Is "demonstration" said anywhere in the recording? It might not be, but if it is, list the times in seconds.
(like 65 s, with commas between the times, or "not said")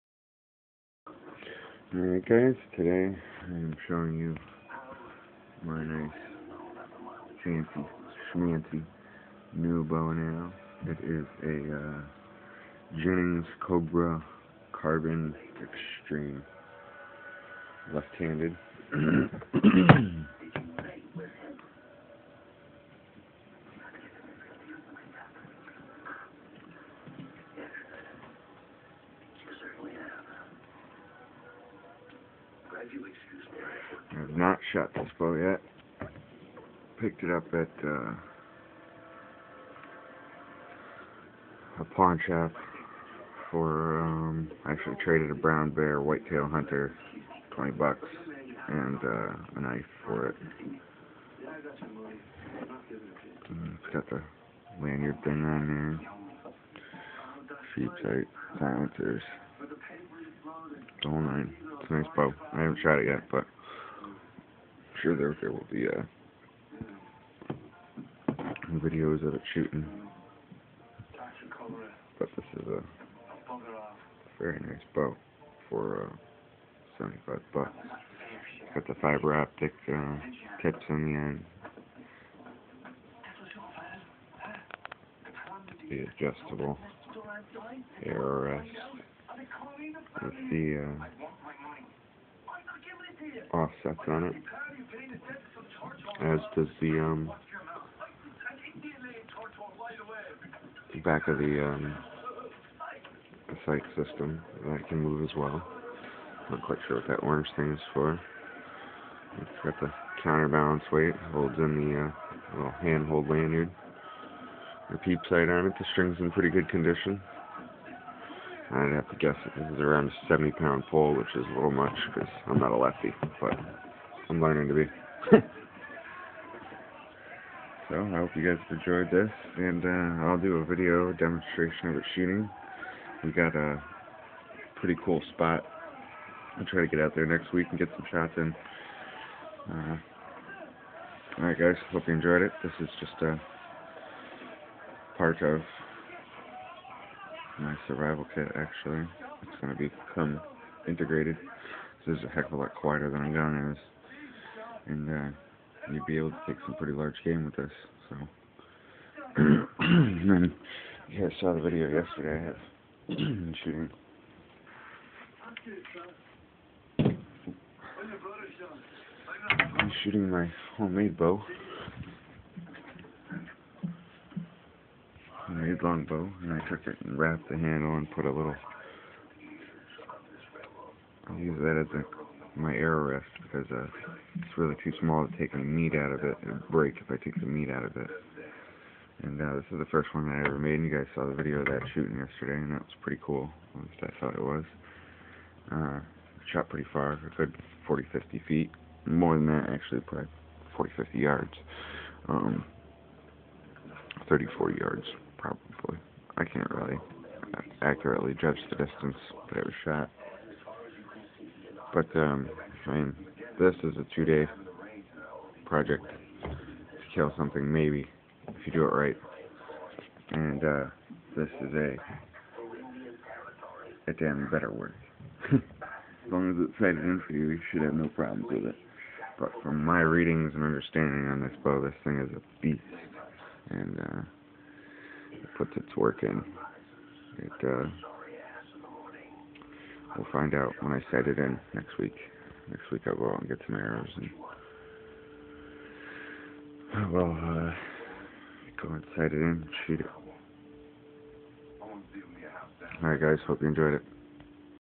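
131 s.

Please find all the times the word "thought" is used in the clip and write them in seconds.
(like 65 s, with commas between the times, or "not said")
194 s.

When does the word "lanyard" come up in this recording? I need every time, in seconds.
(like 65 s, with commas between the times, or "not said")
54 s, 113 s.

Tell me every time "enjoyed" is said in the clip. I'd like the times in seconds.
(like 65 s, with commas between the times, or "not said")
128 s, 142 s, 253 s.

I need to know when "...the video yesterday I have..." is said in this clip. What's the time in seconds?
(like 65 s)
161 s.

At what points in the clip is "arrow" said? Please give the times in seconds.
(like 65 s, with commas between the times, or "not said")
10 s, 182 s, 243 s.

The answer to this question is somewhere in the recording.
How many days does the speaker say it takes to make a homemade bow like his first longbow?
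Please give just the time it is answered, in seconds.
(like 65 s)
214 s.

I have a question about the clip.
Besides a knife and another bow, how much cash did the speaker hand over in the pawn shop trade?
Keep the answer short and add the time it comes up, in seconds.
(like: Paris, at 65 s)
$20, at 47 s.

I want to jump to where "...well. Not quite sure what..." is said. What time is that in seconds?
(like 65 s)
105 s.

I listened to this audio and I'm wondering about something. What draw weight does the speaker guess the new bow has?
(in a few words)
70 pounds.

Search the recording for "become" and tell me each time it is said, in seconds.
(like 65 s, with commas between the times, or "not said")
149 s.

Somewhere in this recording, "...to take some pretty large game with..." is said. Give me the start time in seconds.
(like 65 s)
156 s.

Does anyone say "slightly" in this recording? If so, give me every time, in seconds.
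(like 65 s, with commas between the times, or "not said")
not said.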